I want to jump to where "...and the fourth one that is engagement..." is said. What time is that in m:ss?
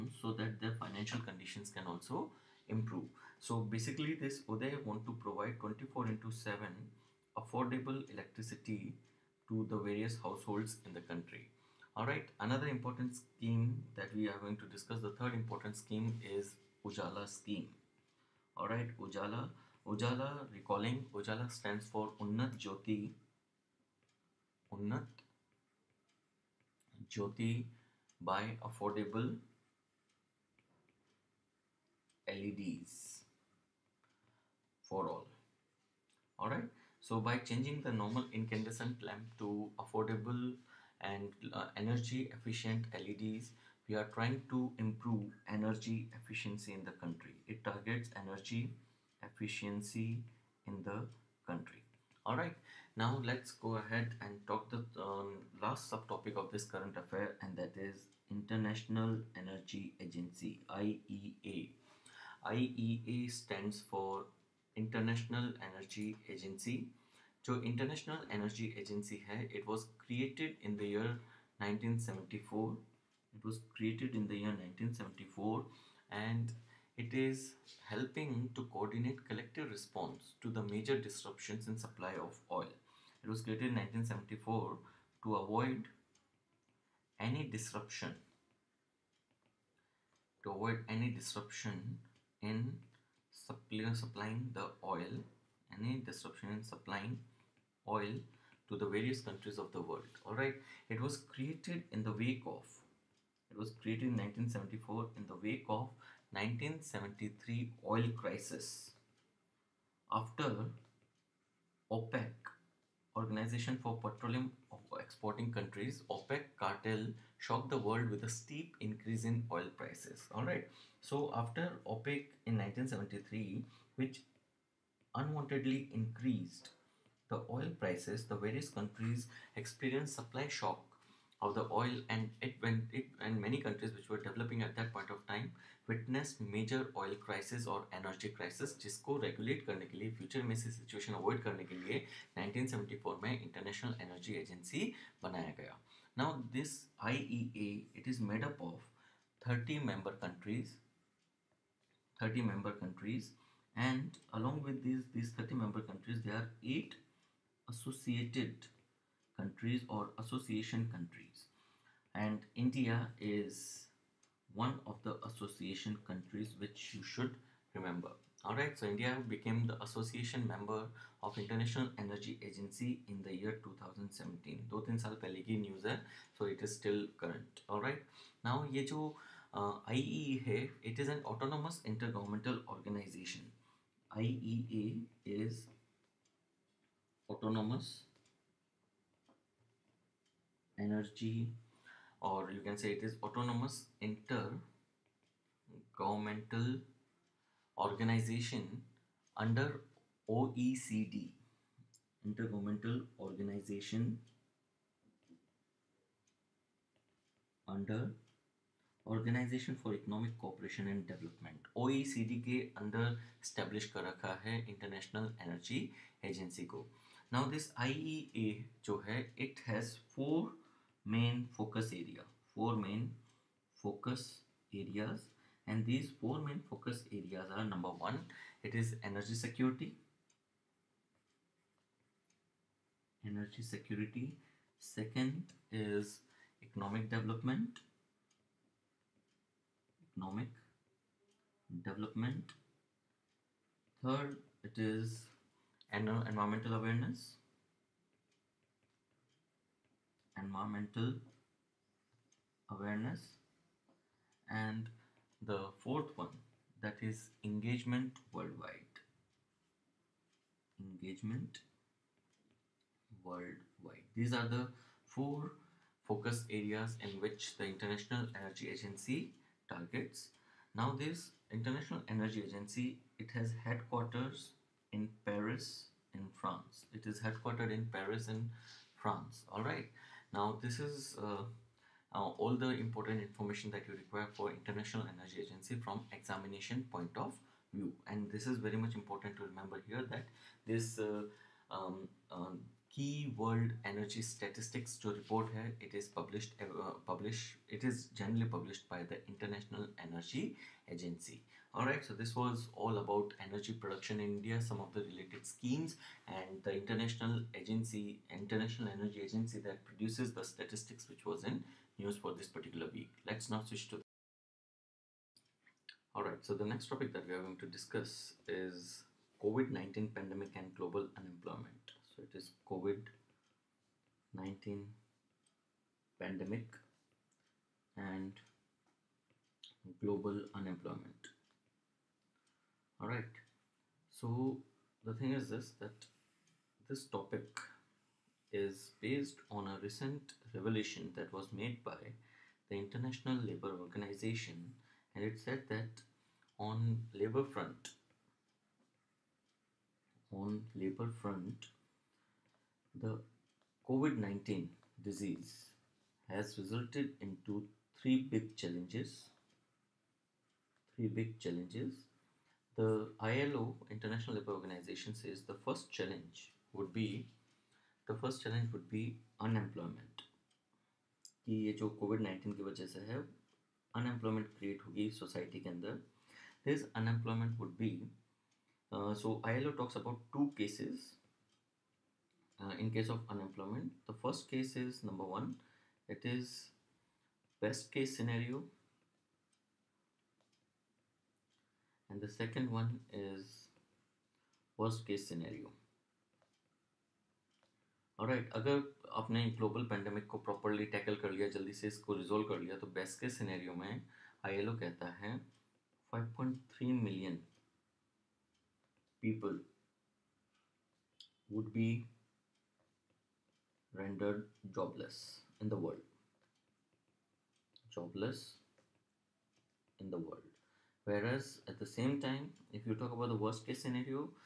4:14.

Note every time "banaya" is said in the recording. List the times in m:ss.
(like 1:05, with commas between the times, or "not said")
2:25.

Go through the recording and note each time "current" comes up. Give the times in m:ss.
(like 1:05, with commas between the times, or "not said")
0:56, 2:57.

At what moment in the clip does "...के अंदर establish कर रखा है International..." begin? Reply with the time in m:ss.
3:32.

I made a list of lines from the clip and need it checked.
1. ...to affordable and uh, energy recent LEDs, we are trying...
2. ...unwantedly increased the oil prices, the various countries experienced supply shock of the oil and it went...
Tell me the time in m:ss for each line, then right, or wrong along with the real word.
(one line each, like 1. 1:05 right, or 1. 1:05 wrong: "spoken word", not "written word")
1. 0:39 wrong: "efficient", not "recent"
2. 2:05 right.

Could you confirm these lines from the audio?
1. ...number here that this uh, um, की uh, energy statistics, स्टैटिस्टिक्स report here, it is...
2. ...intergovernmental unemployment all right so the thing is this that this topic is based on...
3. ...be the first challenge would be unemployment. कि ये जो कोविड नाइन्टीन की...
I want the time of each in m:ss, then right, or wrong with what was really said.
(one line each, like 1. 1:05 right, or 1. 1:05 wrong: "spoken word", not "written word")
1. 4:49 wrong: "remember", not "number"
2. 5:30 wrong: "global", not "intergovernmental"
3. 6:06 right.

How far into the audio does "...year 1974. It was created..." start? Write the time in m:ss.
1:10.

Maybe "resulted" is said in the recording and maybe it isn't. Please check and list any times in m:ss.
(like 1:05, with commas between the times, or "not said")
5:56.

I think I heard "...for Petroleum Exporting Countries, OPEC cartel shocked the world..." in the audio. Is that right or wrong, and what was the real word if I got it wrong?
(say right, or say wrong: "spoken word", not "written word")
right.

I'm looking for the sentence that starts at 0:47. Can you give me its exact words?
It targets energy efficiency in the country.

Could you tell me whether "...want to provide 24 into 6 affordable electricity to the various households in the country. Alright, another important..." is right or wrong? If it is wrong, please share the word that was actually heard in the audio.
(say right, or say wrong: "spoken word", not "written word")
wrong: "7", not "6".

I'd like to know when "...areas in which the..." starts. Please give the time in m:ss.
4:26.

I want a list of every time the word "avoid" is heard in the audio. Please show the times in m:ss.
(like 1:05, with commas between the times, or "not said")
1:25, 1:30, 2:21.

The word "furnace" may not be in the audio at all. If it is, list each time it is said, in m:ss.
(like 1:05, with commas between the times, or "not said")
not said.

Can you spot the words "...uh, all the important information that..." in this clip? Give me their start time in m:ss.
4:41.